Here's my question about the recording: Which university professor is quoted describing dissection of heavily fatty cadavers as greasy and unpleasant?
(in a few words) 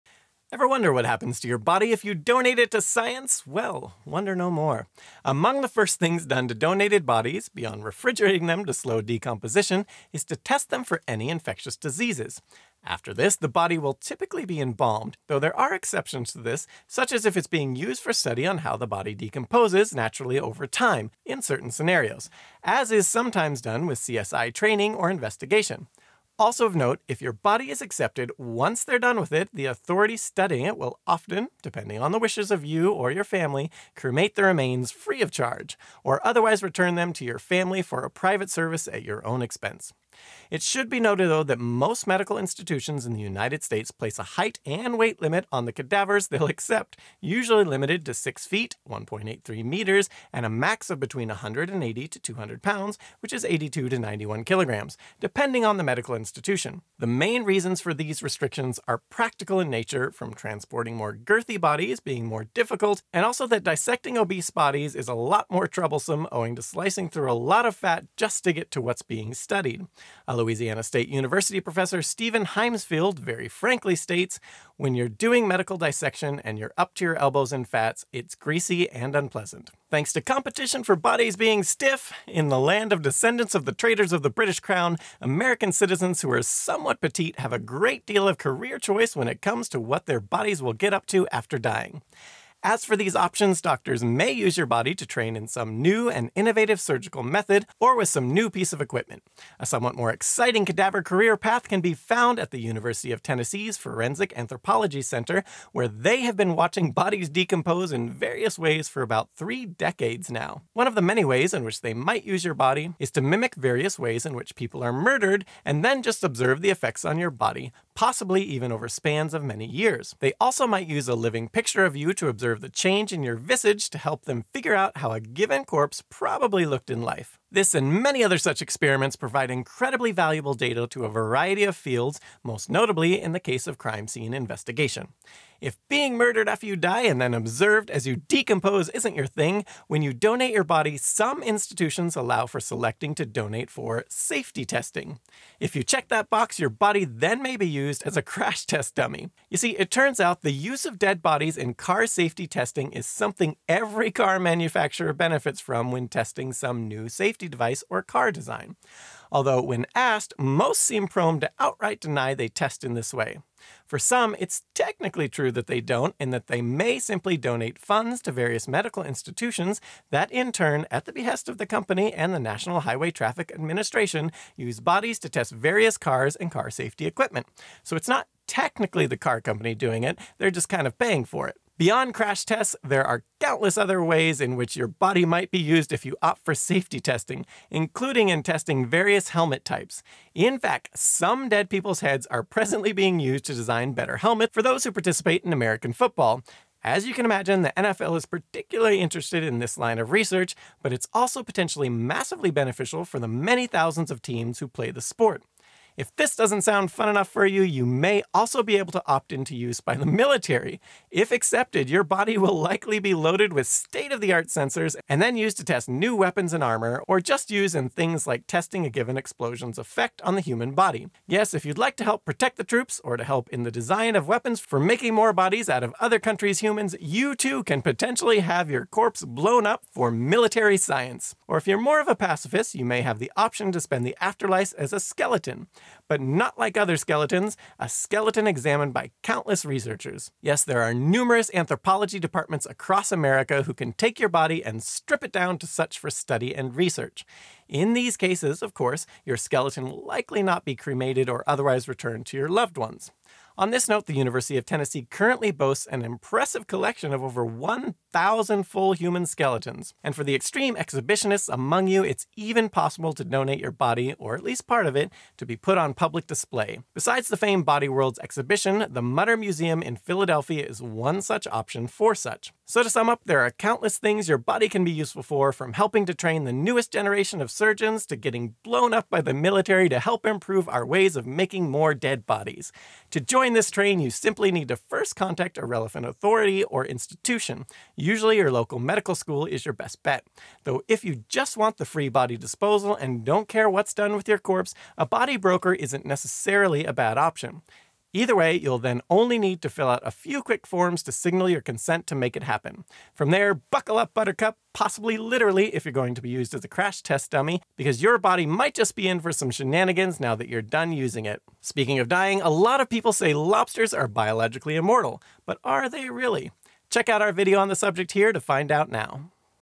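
Steven Heymsfield.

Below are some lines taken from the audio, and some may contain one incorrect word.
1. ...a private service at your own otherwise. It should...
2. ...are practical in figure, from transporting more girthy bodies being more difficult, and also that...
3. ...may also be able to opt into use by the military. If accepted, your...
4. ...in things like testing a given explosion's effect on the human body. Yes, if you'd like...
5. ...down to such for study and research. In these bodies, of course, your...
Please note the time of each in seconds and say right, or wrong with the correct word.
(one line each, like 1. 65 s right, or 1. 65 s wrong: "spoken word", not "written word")
1. 38 s wrong: "expense", not "otherwise"
2. 58 s wrong: "nature", not "figure"
3. 207 s right
4. 217 s right
5. 245 s wrong: "cases", not "bodies".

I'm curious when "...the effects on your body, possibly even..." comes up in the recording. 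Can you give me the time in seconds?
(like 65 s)
116 s.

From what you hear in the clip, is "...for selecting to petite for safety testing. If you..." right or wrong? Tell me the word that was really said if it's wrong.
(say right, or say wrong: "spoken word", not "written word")
wrong: "donate", not "petite".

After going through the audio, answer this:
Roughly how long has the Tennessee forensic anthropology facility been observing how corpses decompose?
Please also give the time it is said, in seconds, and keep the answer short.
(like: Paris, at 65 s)
about three decades, at 109 s.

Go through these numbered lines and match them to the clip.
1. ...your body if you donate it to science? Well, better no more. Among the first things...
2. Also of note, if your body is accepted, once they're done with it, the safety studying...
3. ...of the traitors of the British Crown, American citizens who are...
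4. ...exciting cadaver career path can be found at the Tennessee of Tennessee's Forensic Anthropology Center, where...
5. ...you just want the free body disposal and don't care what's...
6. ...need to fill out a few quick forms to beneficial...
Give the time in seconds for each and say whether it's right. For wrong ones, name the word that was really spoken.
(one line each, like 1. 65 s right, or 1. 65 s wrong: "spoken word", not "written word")
1. 1 s wrong: "wonder", not "better"
2. 26 s wrong: "authority", not "safety"
3. 83 s right
4. 100 s wrong: "University", not "Tennessee"
5. 291 s right
6. 299 s wrong: "signal", not "beneficial".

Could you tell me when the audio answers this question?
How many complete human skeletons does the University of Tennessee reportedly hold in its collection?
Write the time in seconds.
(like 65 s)
257 s.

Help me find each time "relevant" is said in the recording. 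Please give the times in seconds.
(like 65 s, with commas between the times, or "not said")
285 s.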